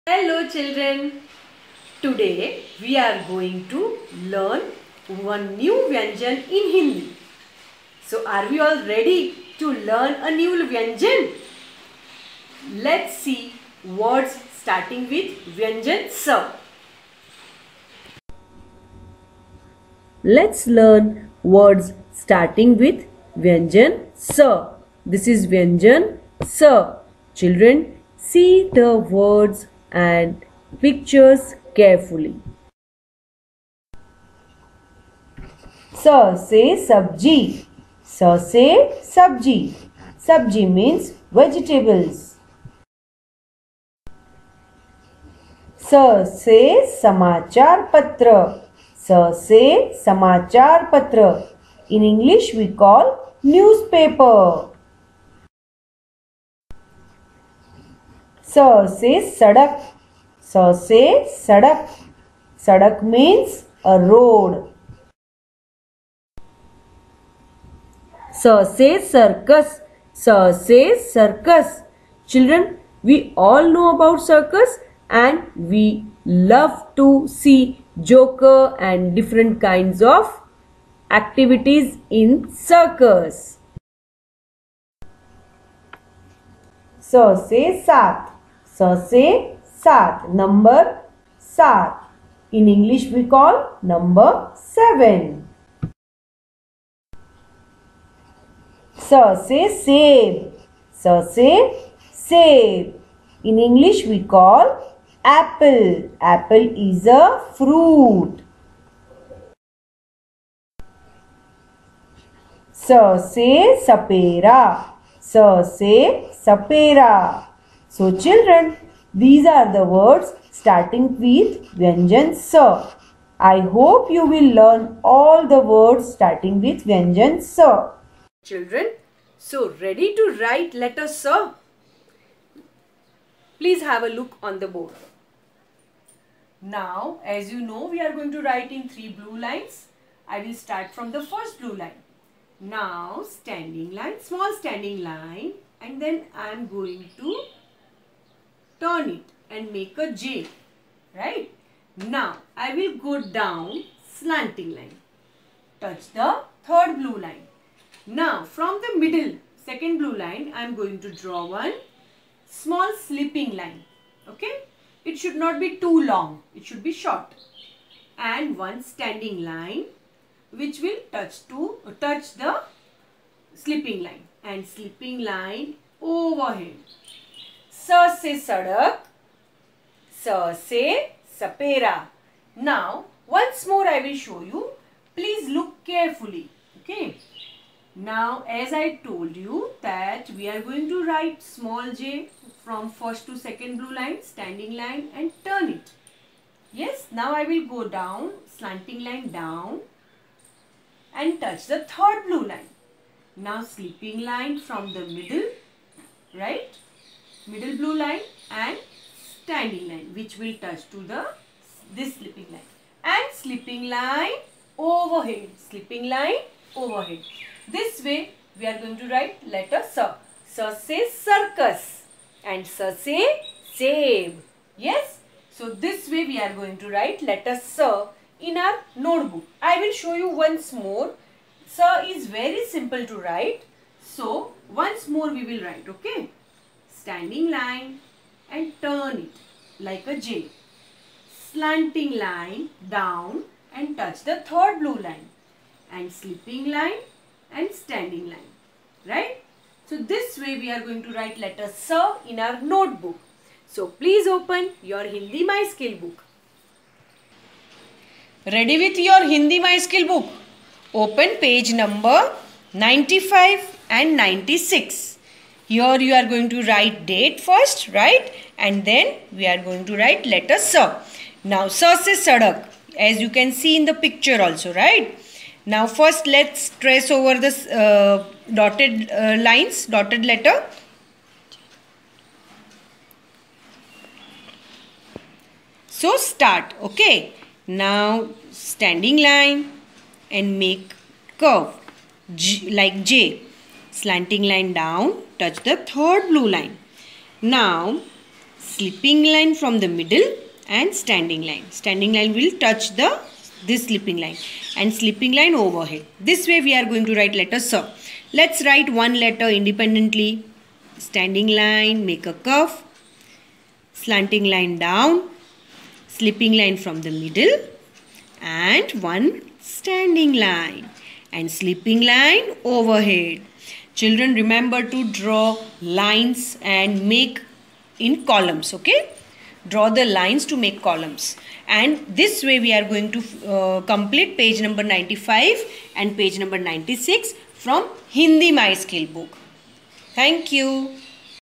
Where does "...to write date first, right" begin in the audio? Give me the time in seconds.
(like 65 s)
266 s.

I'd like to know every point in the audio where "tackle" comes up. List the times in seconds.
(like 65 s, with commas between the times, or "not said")
not said.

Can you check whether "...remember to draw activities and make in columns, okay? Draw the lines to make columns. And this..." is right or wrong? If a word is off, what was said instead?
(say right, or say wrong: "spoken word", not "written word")
wrong: "lines", not "activities".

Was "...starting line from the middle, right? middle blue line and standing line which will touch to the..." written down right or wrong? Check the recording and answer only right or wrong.
wrong.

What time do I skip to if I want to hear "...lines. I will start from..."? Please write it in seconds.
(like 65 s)
139 s.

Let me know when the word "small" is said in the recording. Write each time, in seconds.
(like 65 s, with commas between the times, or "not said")
144 s, 162 s, 191 s.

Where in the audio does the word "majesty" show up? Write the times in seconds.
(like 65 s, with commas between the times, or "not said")
not said.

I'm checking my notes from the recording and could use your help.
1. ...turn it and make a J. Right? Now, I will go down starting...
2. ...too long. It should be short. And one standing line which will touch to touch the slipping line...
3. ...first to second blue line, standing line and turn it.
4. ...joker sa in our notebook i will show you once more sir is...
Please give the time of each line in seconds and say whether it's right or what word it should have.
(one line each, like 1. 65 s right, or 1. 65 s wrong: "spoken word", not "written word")
1. 148 s wrong: "slanting", not "starting"
2. 165 s right
3. 192 s right
4. 227 s wrong: "letter", not "joker".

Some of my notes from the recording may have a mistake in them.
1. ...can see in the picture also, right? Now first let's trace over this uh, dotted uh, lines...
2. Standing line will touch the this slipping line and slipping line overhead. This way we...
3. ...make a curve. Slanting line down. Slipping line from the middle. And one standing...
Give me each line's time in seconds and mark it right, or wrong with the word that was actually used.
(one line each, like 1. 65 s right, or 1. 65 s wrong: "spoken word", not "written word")
1. 273 s right
2. 301 s right
3. 312 s right.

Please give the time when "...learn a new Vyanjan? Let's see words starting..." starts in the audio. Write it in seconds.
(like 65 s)
9 s.